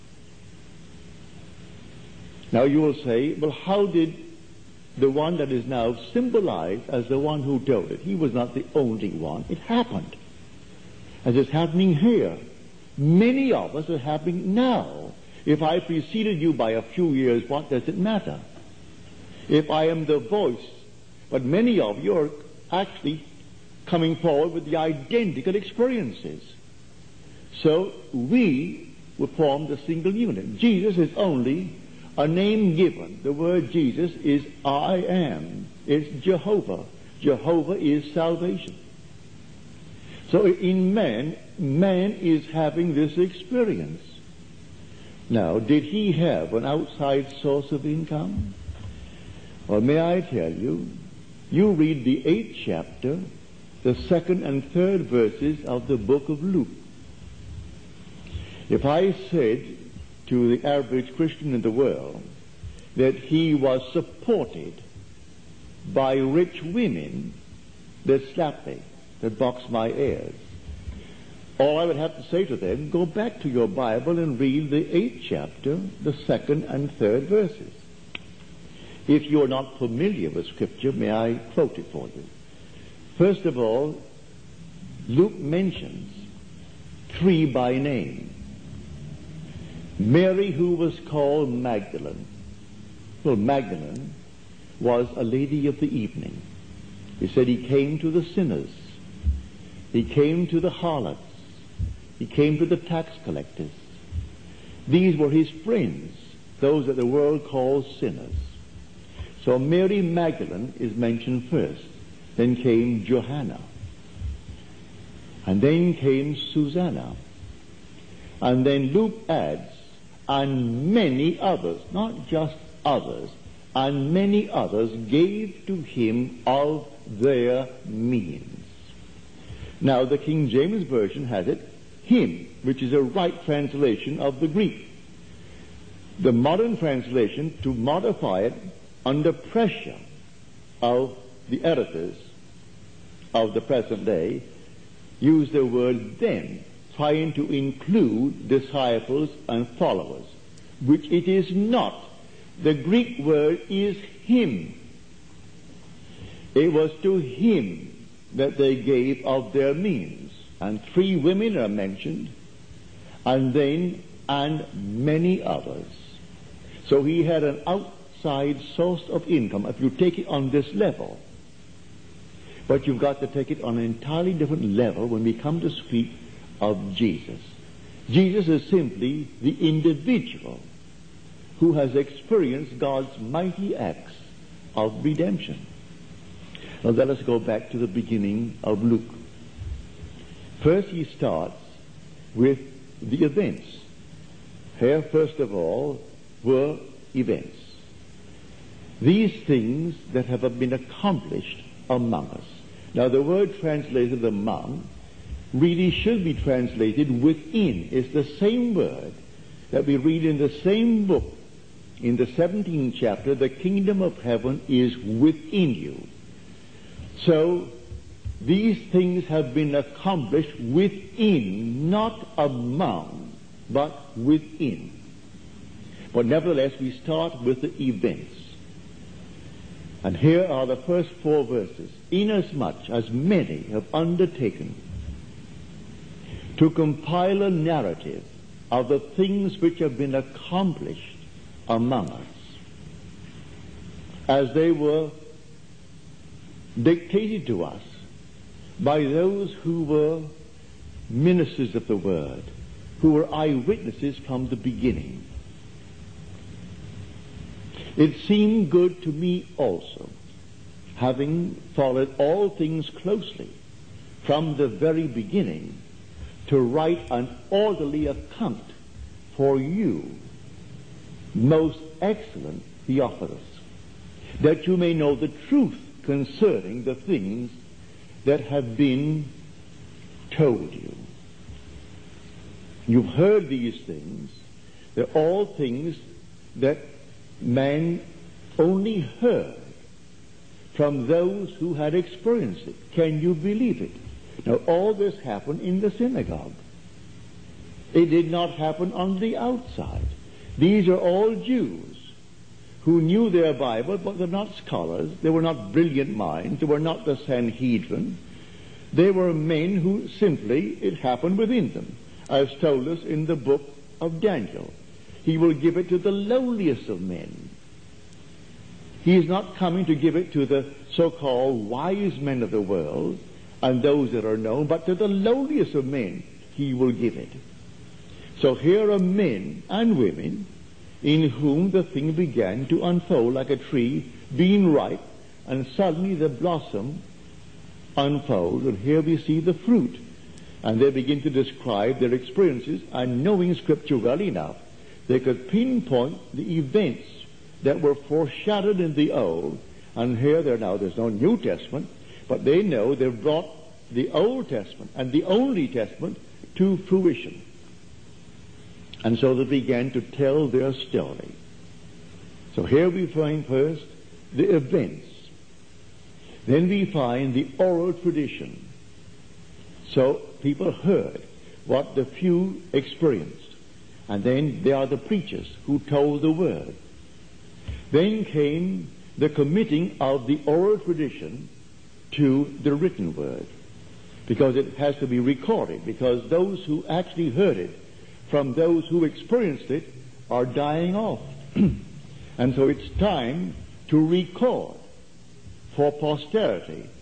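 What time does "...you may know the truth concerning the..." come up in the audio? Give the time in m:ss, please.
4:34.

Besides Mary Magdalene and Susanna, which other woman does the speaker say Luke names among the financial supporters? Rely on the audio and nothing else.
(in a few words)
Johanna.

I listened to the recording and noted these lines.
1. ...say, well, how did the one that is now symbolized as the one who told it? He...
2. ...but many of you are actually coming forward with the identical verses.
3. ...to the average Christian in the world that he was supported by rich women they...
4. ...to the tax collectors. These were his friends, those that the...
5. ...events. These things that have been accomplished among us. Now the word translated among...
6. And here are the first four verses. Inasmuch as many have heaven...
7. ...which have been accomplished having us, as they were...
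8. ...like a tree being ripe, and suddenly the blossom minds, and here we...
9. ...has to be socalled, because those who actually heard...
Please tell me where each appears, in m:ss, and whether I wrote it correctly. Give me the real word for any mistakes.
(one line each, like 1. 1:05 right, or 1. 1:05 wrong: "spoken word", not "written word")
1. 0:02 right
2. 0:21 wrong: "experiences", not "verses"
3. 1:00 right
4. 1:42 right
5. 3:17 right
6. 3:50 wrong: "undertaken", not "heaven"
7. 3:59 wrong: "among", not "having"
8. 5:33 wrong: "unfolds", not "minds"
9. 6:24 wrong: "recorded", not "socalled".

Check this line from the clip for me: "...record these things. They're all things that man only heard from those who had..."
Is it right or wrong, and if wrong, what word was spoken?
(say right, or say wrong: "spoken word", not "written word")
wrong: "heard", not "record".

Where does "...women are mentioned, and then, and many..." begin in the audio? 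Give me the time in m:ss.
2:41.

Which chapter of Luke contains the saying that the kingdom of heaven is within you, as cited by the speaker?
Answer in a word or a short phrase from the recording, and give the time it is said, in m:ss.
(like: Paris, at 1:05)
17th chapter, at 3:32.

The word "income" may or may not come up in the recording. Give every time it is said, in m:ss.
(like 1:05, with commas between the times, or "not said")
0:47, 2:49.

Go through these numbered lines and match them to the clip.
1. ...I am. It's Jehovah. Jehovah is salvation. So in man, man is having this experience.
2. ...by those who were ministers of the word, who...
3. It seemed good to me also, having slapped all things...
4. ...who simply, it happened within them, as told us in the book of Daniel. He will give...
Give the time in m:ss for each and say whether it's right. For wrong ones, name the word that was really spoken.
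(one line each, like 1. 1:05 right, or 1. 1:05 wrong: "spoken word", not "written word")
1. 0:34 right
2. 4:08 right
3. 4:17 wrong: "followed", not "slapped"
4. 5:09 right.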